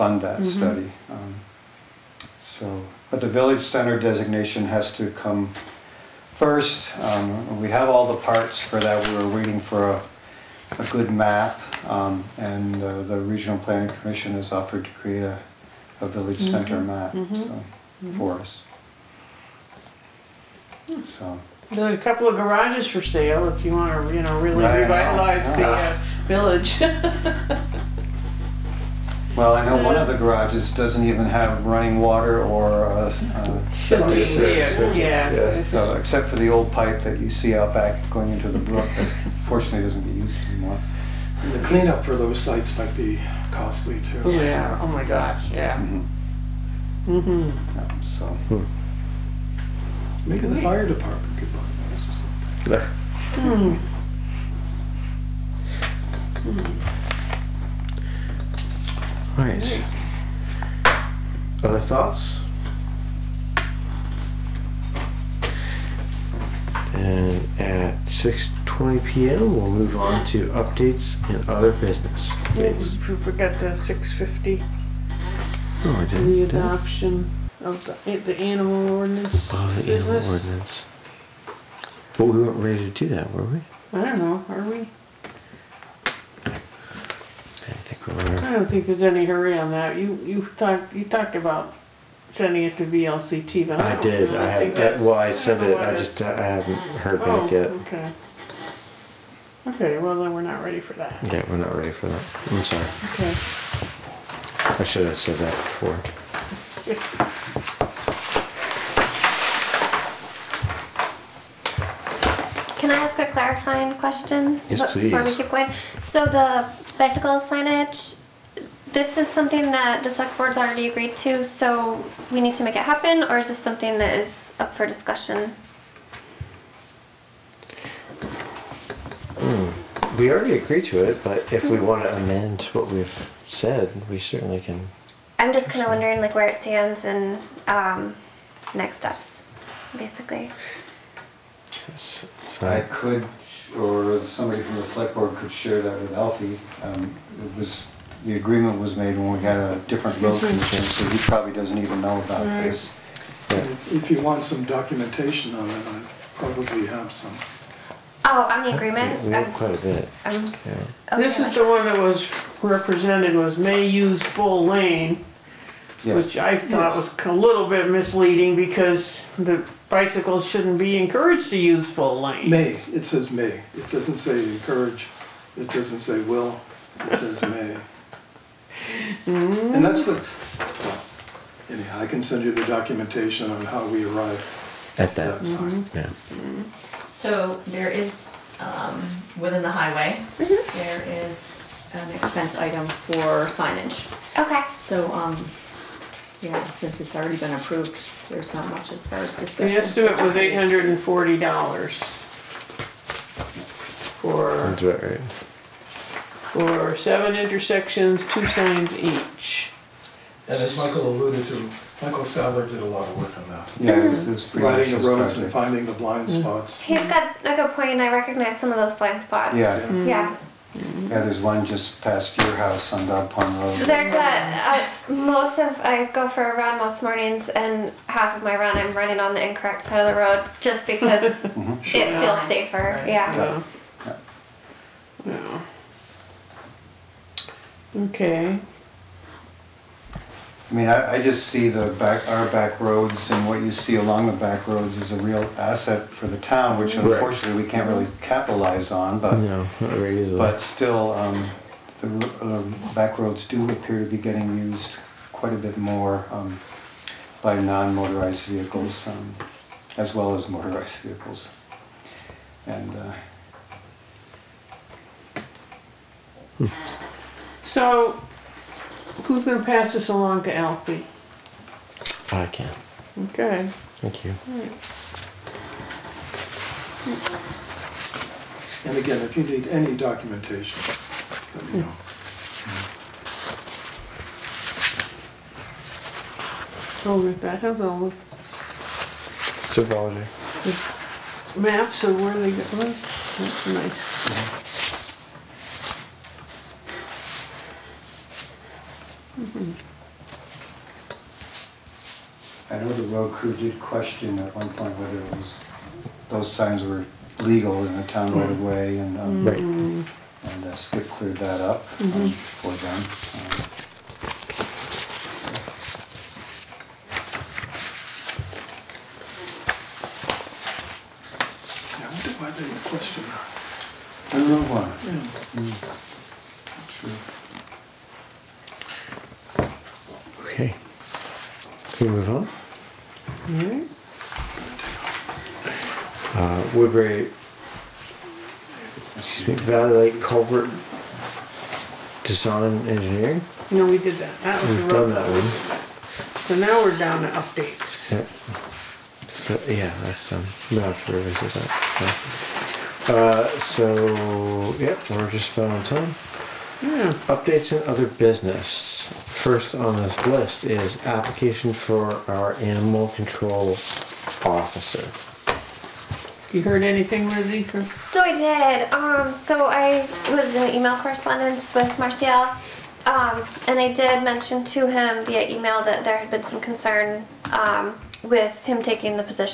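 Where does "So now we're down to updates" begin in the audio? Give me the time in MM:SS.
05:46.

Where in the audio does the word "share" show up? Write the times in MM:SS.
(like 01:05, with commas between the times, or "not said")
02:25.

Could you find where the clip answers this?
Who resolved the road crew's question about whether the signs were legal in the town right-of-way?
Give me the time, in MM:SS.
05:10.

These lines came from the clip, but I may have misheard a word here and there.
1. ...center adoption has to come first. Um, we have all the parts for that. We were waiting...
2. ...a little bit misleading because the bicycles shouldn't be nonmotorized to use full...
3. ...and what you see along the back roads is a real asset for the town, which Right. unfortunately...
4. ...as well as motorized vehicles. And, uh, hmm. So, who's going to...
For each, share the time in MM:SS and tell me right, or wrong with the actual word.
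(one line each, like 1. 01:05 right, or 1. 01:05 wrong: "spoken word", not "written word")
1. 00:03 wrong: "designation", not "adoption"
2. 02:47 wrong: "encouraged", not "nonmotorized"
3. 04:03 right
4. 04:19 right.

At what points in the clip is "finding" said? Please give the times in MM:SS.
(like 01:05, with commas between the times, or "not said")
03:35.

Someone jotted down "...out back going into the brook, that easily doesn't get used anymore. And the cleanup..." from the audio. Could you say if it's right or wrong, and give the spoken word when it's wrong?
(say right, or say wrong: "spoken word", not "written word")
wrong: "fortunately", not "easily".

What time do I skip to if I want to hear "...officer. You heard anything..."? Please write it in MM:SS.
06:04.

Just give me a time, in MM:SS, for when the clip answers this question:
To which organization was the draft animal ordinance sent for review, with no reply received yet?
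01:32.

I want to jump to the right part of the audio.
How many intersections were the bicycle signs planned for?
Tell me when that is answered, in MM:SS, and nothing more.
03:26.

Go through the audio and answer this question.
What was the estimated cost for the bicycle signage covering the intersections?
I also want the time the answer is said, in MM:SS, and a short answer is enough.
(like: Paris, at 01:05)
$840, at 03:20.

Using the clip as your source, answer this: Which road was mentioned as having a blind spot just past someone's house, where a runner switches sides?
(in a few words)
Dog Pond Road.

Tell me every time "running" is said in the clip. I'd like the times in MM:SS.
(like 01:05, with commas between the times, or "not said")
00:31, 03:48.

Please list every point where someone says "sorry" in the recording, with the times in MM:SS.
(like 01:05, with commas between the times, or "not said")
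01:42.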